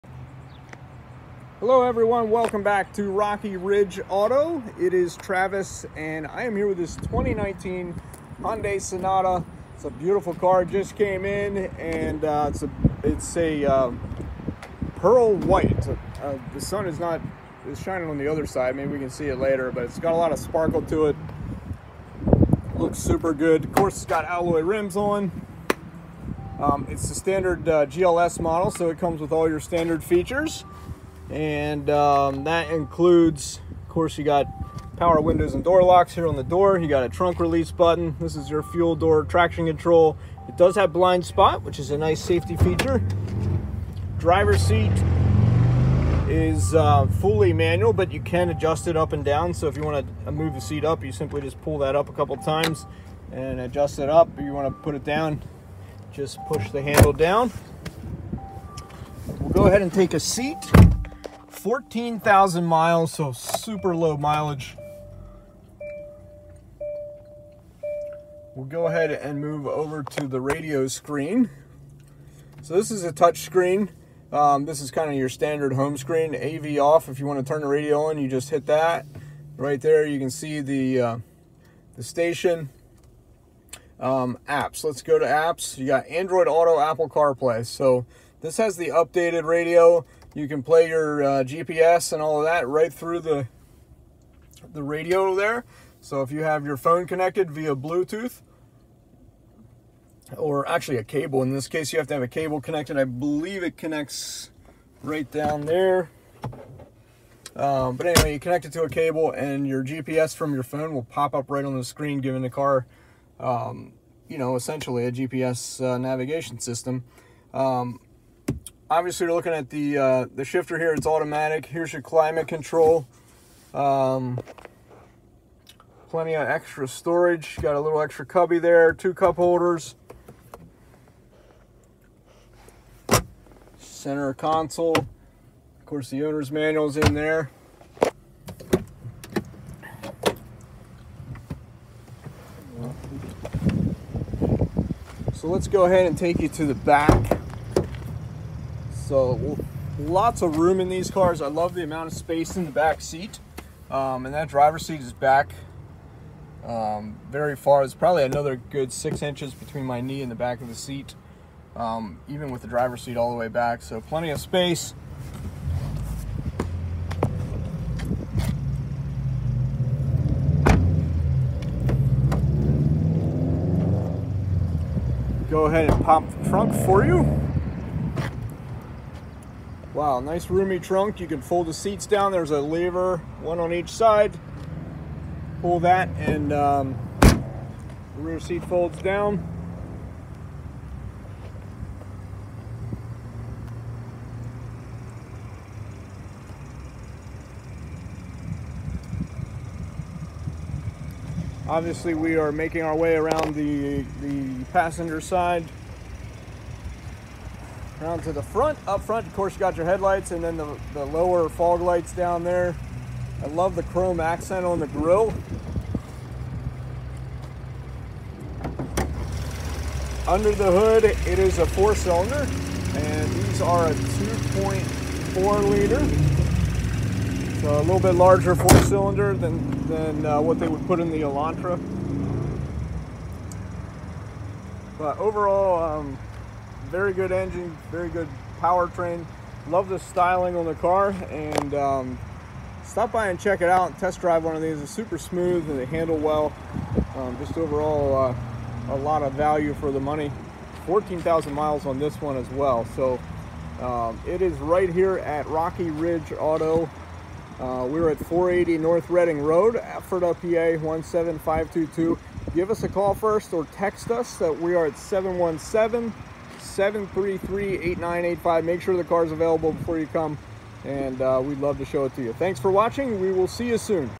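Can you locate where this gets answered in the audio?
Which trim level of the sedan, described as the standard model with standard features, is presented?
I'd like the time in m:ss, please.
0:27.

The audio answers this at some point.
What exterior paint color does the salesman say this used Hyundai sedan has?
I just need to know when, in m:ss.
0:14.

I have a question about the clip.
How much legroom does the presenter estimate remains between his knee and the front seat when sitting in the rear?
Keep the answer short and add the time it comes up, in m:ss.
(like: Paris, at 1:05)
6 inches, at 2:38.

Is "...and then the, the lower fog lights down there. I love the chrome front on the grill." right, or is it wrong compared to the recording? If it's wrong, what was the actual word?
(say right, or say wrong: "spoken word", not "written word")
wrong: "accent", not "front".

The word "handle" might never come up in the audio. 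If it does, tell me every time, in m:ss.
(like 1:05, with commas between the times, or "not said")
0:56, 4:05.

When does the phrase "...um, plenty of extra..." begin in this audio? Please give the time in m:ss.
2:03.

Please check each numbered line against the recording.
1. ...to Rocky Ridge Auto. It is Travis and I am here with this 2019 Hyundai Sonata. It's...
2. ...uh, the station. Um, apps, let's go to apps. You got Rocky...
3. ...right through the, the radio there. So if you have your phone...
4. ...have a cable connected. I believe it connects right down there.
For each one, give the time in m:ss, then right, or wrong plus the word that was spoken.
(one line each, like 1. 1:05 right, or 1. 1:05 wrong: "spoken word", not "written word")
1. 0:02 right
2. 1:20 wrong: "Android", not "Rocky"
3. 1:32 right
4. 1:42 right.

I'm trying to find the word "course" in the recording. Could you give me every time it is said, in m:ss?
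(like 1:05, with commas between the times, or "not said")
0:23, 0:33, 2:15, 3:29.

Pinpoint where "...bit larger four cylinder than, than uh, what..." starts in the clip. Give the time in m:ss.
3:47.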